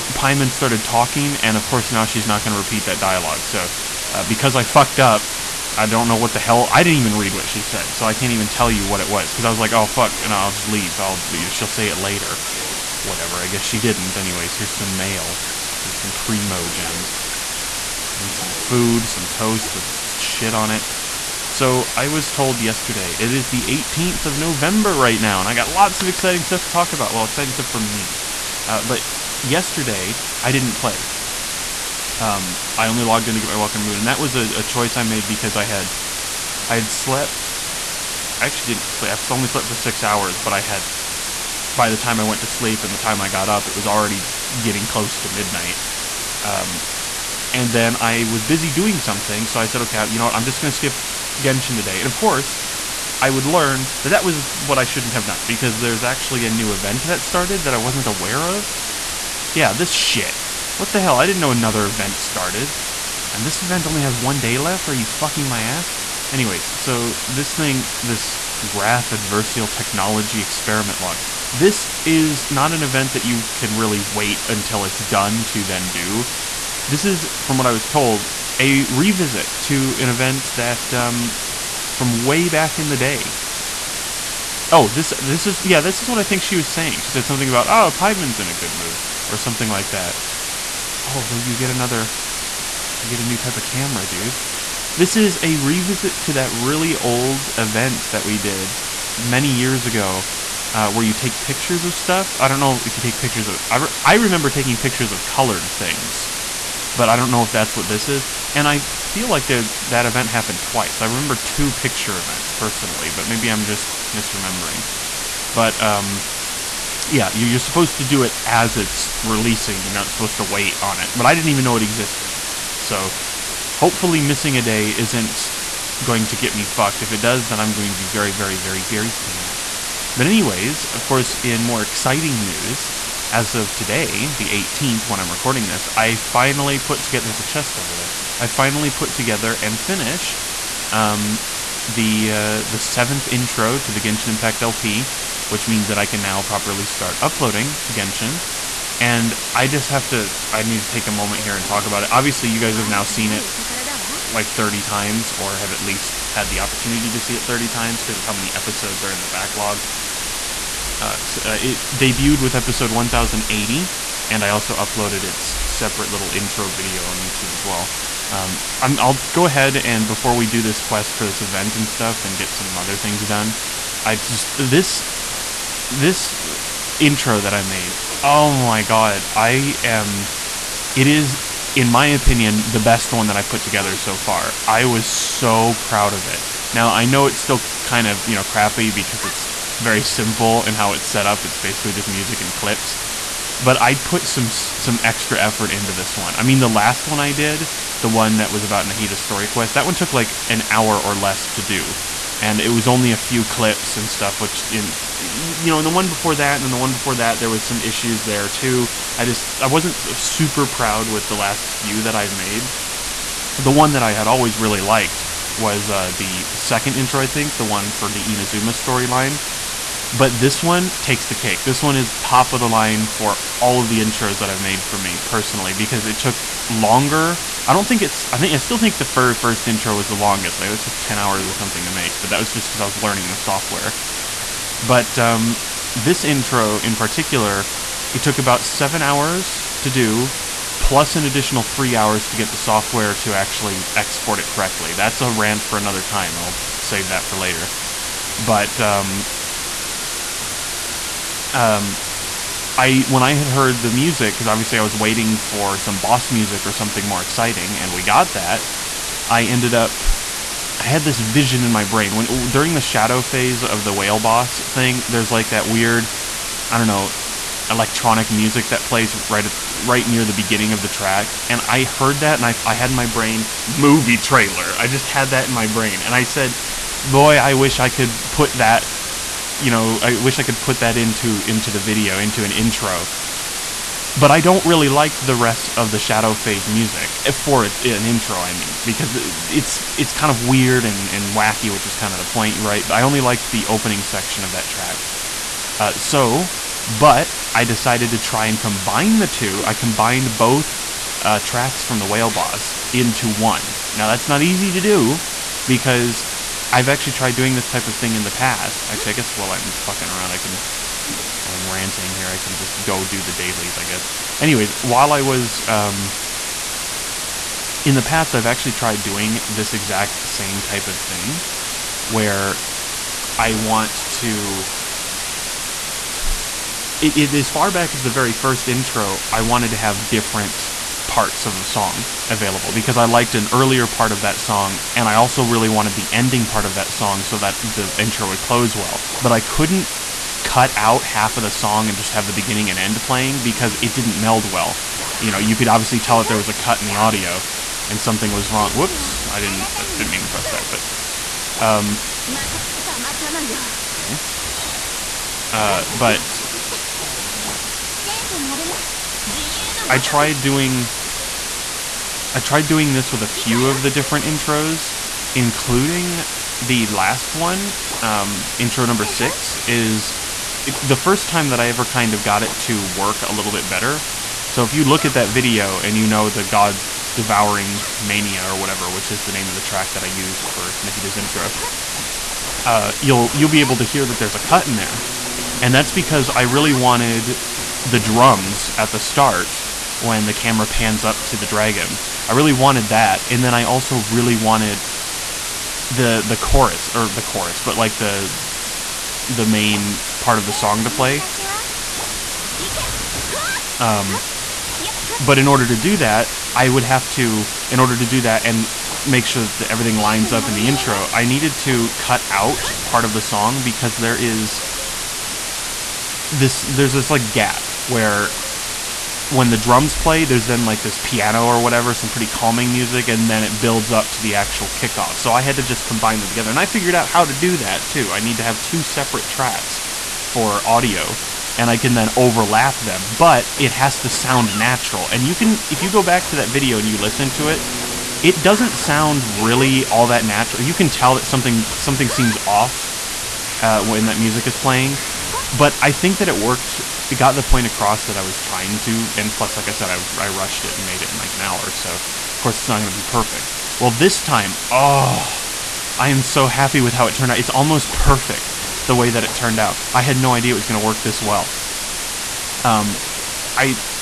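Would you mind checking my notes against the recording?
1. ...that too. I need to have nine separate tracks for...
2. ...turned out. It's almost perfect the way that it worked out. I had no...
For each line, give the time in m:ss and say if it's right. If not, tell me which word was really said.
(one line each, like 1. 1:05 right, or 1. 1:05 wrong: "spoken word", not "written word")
1. 7:07 wrong: "two", not "nine"
2. 7:37 wrong: "turned", not "worked".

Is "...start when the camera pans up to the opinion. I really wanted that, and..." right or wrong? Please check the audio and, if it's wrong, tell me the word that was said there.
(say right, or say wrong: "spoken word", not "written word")
wrong: "dragon", not "opinion".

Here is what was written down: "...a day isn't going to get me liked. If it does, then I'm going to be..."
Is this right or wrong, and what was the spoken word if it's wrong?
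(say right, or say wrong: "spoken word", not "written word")
wrong: "fucked", not "liked".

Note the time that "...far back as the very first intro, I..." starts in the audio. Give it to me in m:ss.
5:27.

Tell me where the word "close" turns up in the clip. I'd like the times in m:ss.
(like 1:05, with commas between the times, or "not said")
0:44, 5:38.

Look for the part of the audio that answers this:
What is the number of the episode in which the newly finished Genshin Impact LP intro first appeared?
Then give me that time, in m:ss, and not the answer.
2:42.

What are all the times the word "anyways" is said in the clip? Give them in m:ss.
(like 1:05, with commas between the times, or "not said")
0:14, 1:06, 2:10, 5:14.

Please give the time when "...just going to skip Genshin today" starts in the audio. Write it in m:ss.
0:50.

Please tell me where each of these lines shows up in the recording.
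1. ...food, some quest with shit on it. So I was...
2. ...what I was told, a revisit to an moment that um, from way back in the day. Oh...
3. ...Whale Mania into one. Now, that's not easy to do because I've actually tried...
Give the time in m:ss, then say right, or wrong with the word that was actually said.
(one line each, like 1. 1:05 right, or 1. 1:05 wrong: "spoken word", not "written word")
1. 0:18 wrong: "toast", not "quest"
2. 1:17 wrong: "event", not "moment"
3. 5:02 wrong: "Boss", not "Mania".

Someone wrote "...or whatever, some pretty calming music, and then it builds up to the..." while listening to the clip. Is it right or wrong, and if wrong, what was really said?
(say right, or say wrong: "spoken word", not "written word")
right.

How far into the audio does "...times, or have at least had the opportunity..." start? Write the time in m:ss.
2:34.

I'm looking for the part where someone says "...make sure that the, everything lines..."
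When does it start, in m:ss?
6:49.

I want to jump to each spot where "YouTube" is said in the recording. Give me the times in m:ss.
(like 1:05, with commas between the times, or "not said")
2:47.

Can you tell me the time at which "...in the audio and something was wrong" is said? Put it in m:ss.
5:46.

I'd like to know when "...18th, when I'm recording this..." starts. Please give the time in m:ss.
2:14.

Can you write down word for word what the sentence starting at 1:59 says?
You're not supposed to wait on it.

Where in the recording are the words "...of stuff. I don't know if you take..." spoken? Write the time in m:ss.
1:41.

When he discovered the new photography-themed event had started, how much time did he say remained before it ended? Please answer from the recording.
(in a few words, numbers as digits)
one day.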